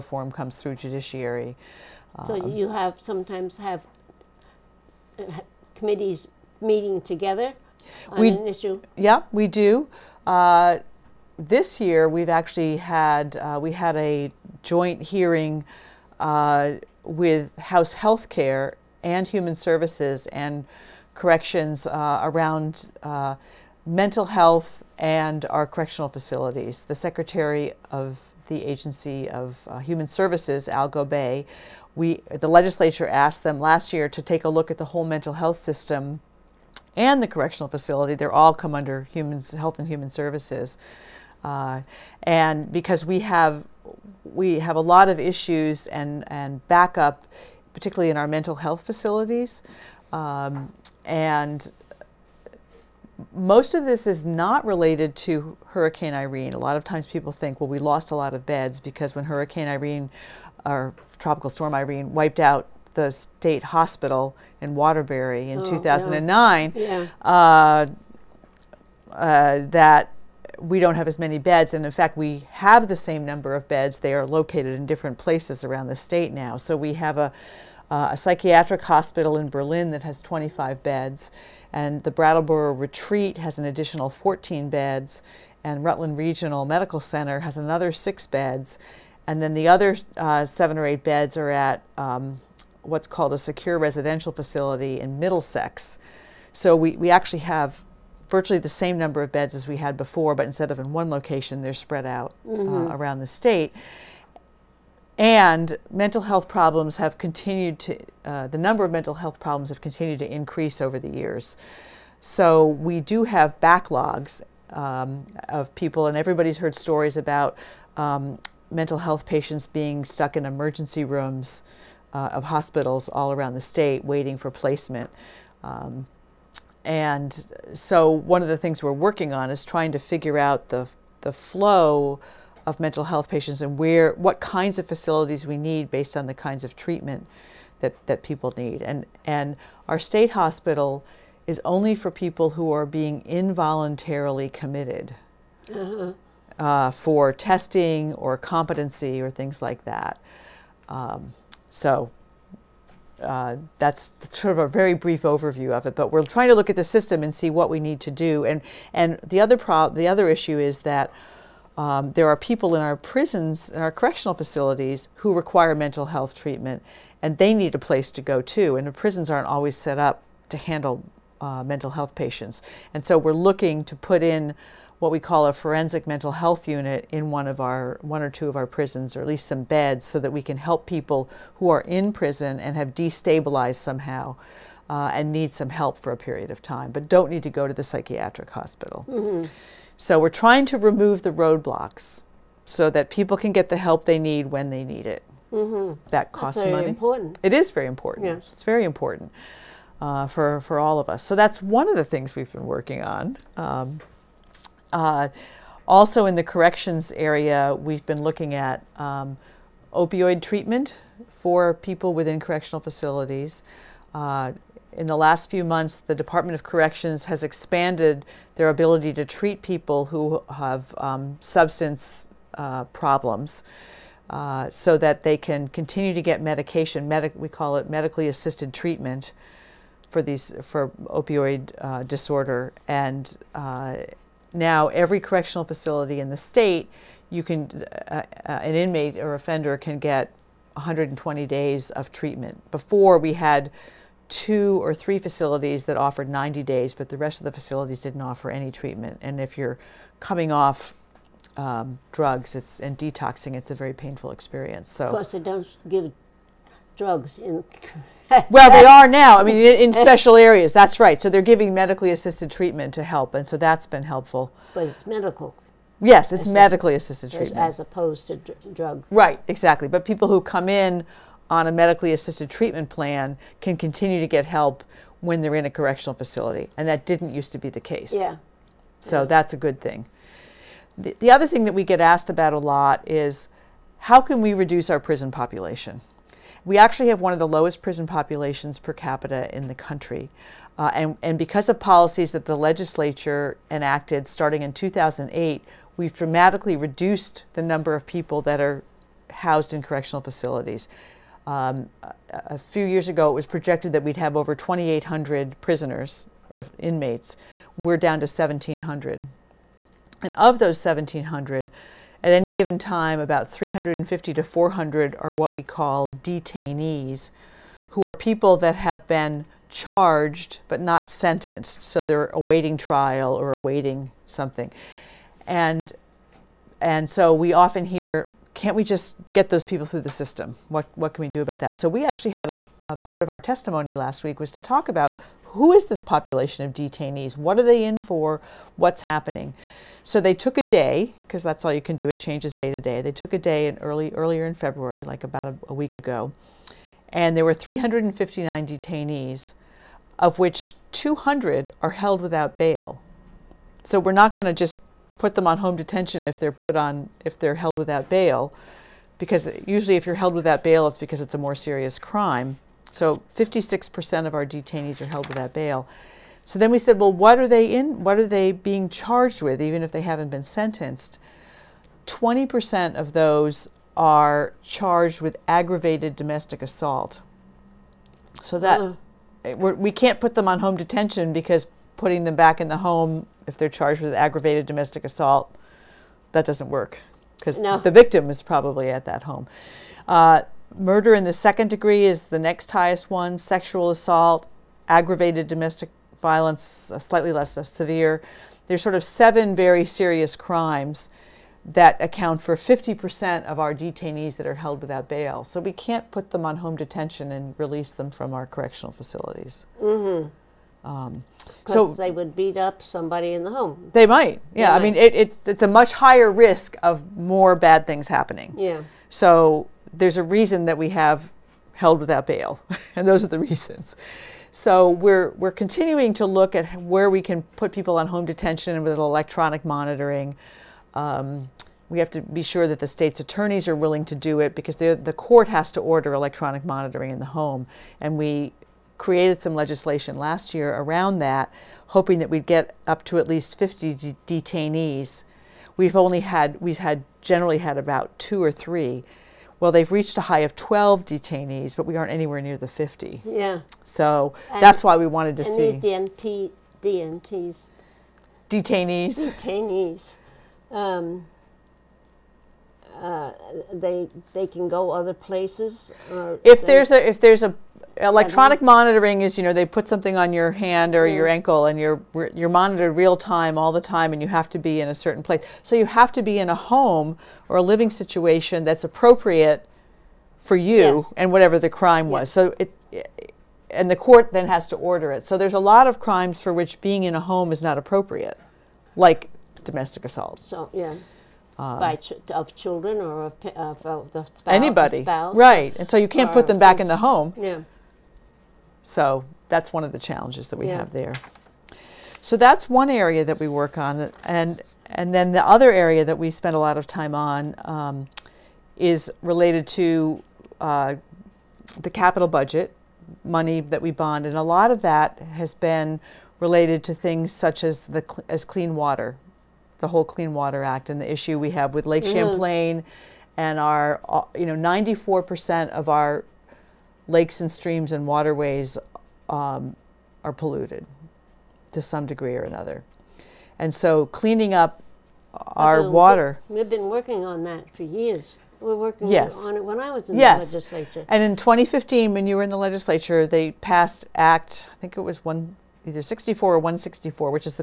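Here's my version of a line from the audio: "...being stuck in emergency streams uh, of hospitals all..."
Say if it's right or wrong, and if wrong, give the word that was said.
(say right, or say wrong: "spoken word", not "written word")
wrong: "rooms", not "streams".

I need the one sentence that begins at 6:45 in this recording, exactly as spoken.
So we can't put them on home detention and release them from our correctional facilities.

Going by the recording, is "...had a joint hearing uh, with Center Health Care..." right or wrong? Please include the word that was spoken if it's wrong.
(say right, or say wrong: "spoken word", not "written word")
wrong: "House", not "Center".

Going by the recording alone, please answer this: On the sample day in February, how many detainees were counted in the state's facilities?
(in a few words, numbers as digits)
359.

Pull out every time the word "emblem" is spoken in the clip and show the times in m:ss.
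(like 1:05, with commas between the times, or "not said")
not said.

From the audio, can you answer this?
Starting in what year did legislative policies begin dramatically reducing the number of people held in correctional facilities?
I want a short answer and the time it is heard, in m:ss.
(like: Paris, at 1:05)
2008, at 4:54.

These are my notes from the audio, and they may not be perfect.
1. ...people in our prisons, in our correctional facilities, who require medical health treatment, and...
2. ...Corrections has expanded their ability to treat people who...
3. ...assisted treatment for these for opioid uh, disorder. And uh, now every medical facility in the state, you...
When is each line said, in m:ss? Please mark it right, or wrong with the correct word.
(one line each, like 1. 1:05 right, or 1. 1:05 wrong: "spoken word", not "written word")
1. 2:42 wrong: "mental", not "medical"
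2. 3:36 right
3. 3:48 wrong: "correctional", not "medical".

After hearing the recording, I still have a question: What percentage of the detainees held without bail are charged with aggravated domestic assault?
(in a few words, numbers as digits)
20%.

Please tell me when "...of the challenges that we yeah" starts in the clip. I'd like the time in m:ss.
8:19.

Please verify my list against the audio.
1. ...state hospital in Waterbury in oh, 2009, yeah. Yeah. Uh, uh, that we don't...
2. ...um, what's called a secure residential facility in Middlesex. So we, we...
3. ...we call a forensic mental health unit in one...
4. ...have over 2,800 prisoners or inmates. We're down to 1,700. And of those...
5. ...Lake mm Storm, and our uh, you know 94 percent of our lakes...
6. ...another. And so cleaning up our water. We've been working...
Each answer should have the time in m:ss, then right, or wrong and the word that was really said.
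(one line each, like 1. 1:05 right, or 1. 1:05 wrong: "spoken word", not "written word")
1. 1:03 right
2. 1:31 right
3. 2:55 right
4. 5:04 right
5. 8:41 wrong: "Champlain", not "Storm"
6. 8:52 right.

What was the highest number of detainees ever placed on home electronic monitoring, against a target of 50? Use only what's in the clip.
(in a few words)
12.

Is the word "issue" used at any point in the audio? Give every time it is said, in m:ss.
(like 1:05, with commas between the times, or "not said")
0:08, 0:45, 2:40, 8:41.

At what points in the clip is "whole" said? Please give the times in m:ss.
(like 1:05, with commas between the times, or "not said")
0:34, 8:39.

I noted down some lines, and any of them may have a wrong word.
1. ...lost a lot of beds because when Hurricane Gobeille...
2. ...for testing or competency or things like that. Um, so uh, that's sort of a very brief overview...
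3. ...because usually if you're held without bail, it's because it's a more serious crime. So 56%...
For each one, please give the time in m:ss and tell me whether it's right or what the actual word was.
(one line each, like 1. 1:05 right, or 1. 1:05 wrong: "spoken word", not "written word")
1. 0:57 wrong: "Irene", not "Gobeille"
2. 2:26 right
3. 5:59 right.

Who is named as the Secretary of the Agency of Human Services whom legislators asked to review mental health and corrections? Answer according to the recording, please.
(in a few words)
Al Gobeille.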